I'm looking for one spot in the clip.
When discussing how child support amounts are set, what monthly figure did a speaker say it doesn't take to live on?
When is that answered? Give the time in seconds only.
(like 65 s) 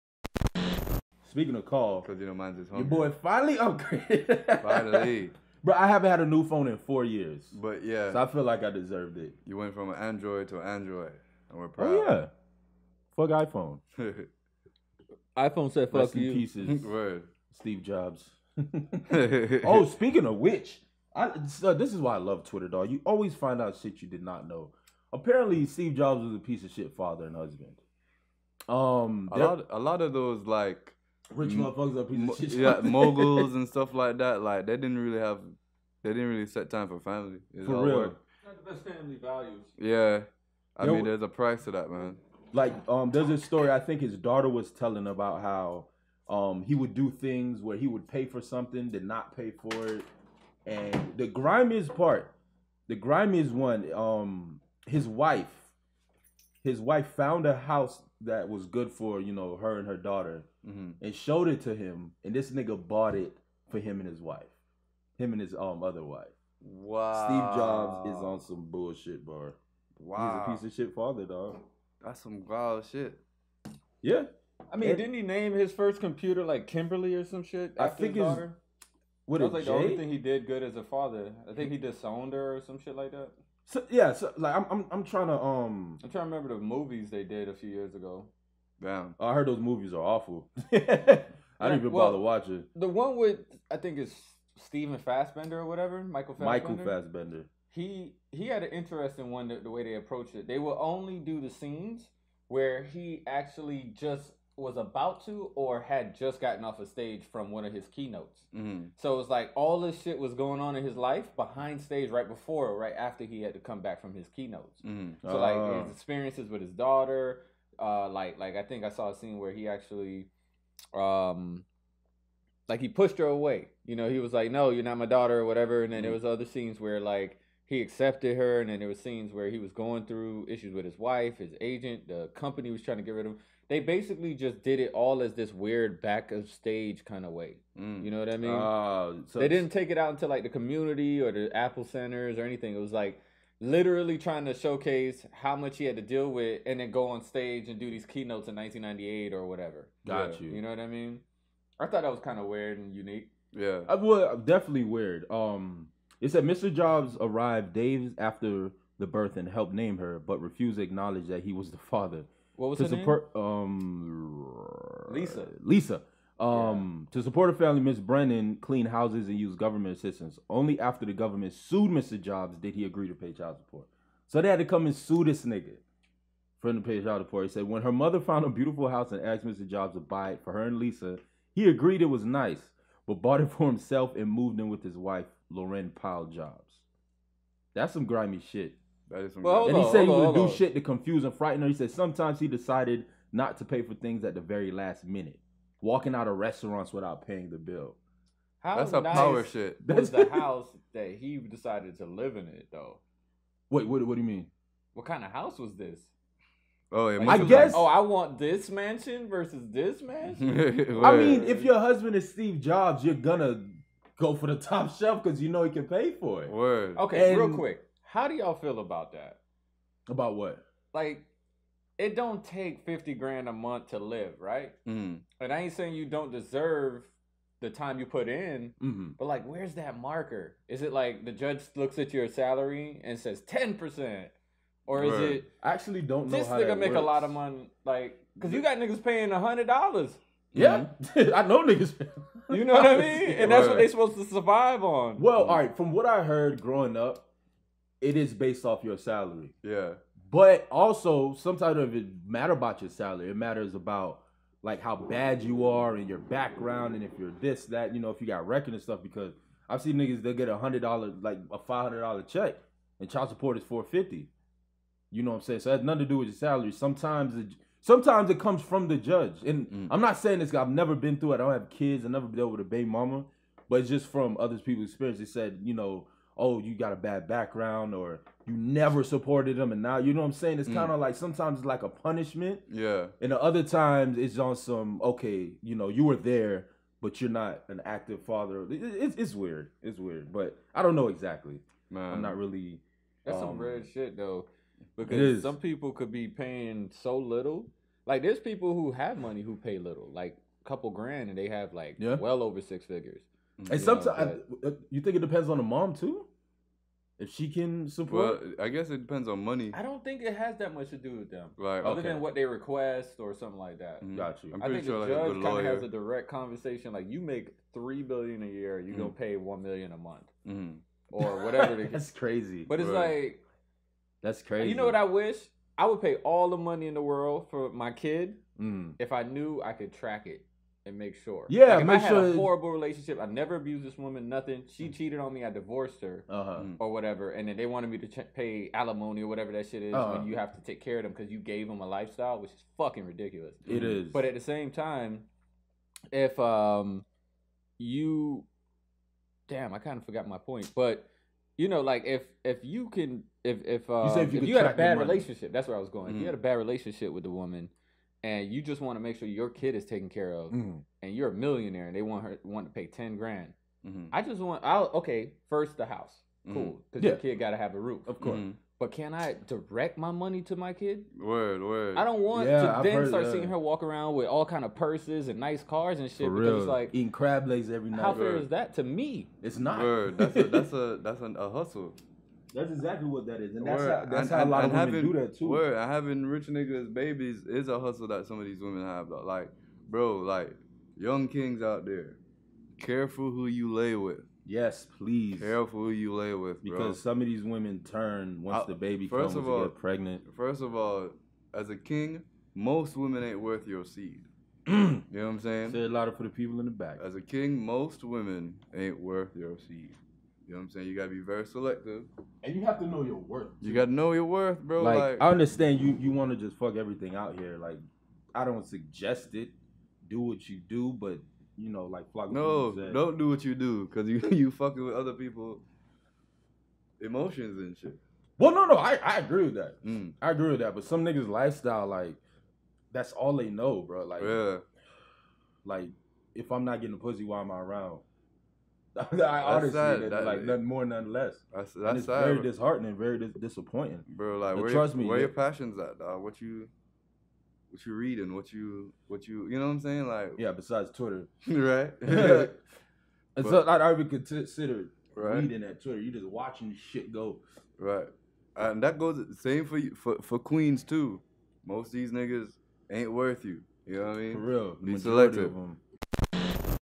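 222 s.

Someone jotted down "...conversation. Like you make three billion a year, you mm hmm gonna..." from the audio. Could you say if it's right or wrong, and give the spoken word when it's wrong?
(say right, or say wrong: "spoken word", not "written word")
right.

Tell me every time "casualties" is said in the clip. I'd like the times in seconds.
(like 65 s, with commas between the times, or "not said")
not said.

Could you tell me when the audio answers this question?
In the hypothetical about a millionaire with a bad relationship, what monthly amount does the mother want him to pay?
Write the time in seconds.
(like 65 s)
362 s.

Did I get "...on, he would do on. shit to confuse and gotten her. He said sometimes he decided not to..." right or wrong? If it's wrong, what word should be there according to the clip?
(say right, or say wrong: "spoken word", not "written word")
wrong: "frighten", not "gotten".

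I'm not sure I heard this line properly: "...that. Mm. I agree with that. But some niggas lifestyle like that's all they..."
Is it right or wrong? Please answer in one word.
right.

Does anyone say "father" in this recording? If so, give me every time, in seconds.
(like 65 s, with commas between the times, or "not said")
26 s, 70 s, 80 s, 161 s, 288 s.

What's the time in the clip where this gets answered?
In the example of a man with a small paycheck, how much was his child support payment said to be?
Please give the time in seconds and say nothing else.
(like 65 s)
263 s.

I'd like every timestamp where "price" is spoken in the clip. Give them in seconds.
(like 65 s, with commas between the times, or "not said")
41 s.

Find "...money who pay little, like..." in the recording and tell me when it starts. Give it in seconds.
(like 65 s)
299 s.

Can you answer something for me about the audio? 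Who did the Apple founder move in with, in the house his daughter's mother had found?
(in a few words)
Laurene Powell Jobs.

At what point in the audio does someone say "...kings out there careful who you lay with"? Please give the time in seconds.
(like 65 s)
391 s.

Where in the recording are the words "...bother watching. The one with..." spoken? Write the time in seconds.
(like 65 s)
92 s.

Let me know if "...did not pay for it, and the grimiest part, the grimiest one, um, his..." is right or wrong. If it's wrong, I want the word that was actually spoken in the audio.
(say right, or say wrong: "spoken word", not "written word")
right.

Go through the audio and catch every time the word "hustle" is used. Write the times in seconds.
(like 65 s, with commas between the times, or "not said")
381 s, 387 s.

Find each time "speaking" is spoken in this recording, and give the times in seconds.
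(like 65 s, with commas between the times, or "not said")
1 s, 19 s.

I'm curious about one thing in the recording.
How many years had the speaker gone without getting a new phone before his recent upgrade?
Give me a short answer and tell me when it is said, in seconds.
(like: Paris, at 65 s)
4, at 6 s.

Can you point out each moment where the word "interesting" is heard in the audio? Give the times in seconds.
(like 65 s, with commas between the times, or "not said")
98 s.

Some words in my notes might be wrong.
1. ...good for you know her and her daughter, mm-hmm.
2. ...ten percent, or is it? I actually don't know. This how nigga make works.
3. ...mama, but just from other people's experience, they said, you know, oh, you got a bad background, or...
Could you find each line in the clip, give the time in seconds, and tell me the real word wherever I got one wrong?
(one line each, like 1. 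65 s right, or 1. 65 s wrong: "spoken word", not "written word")
1. 58 s right
2. 233 s right
3. 272 s right.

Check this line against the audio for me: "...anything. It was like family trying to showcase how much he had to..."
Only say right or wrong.
wrong.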